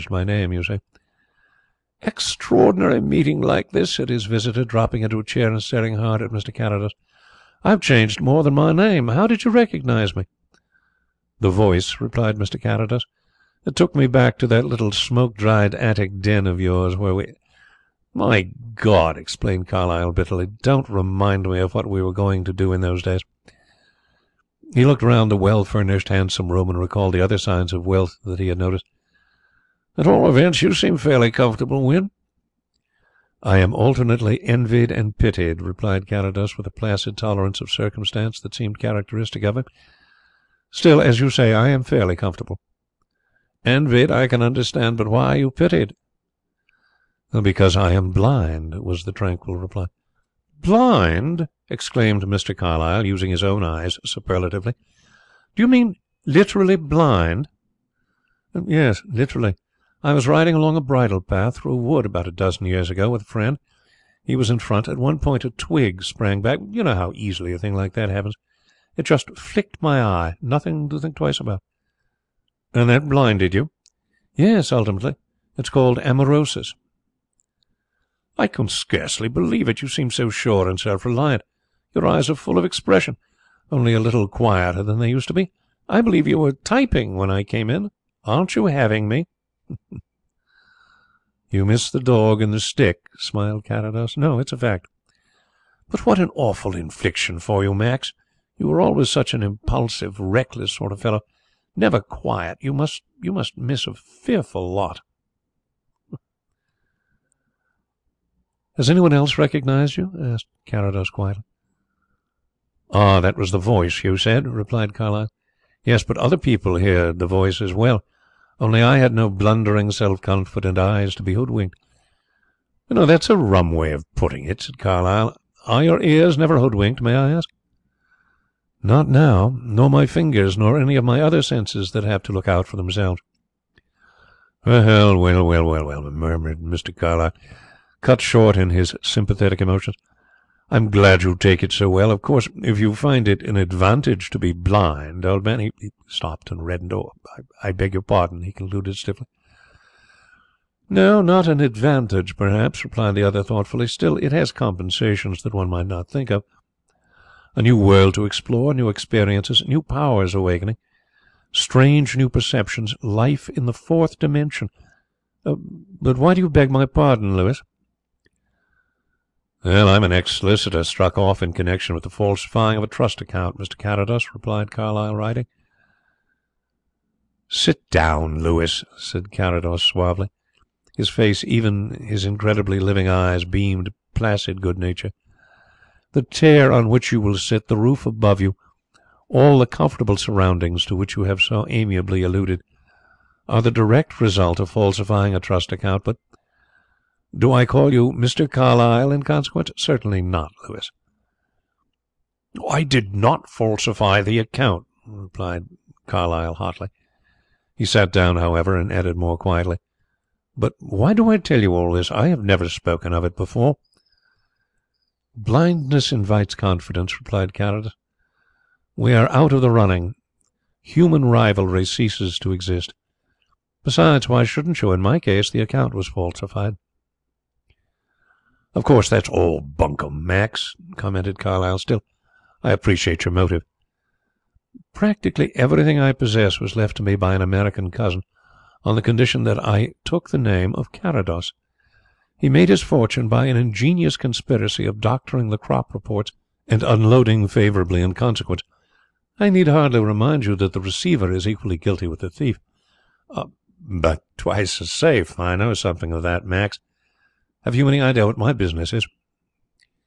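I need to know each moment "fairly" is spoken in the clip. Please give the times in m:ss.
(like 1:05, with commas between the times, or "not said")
0:30, 0:41.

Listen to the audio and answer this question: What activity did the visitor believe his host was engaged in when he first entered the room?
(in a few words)
Typing.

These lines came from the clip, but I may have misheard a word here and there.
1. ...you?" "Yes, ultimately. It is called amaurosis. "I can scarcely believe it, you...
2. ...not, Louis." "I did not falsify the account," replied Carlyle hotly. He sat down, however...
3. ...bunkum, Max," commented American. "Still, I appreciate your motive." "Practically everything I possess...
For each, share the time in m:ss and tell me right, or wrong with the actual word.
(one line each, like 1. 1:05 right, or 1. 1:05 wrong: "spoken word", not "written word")
1. 1:13 right
2. 3:20 right
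3. 3:49 wrong: "Carlyle", not "American".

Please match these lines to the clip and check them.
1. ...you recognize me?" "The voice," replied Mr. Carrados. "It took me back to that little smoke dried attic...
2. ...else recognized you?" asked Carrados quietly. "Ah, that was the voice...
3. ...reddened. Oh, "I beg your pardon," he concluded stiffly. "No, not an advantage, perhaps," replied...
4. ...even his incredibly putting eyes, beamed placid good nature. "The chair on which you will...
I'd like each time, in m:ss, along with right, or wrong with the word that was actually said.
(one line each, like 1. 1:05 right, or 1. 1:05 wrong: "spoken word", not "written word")
1. 0:09 right
2. 1:49 right
3. 2:26 right
4. 3:01 wrong: "living", not "putting".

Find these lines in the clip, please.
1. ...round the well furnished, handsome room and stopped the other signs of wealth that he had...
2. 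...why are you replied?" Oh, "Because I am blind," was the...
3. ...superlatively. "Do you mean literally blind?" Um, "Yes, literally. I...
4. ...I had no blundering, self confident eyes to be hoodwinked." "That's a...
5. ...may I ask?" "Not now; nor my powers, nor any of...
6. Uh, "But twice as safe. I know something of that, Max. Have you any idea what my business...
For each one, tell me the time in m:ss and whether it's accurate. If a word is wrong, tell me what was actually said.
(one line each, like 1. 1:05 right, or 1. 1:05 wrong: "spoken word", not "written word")
1. 0:25 wrong: "recalled", not "stopped"
2. 0:45 wrong: "pitied", not "replied"
3. 0:54 right
4. 1:58 right
5. 2:07 wrong: "fingers", not "powers"
6. 4:13 right.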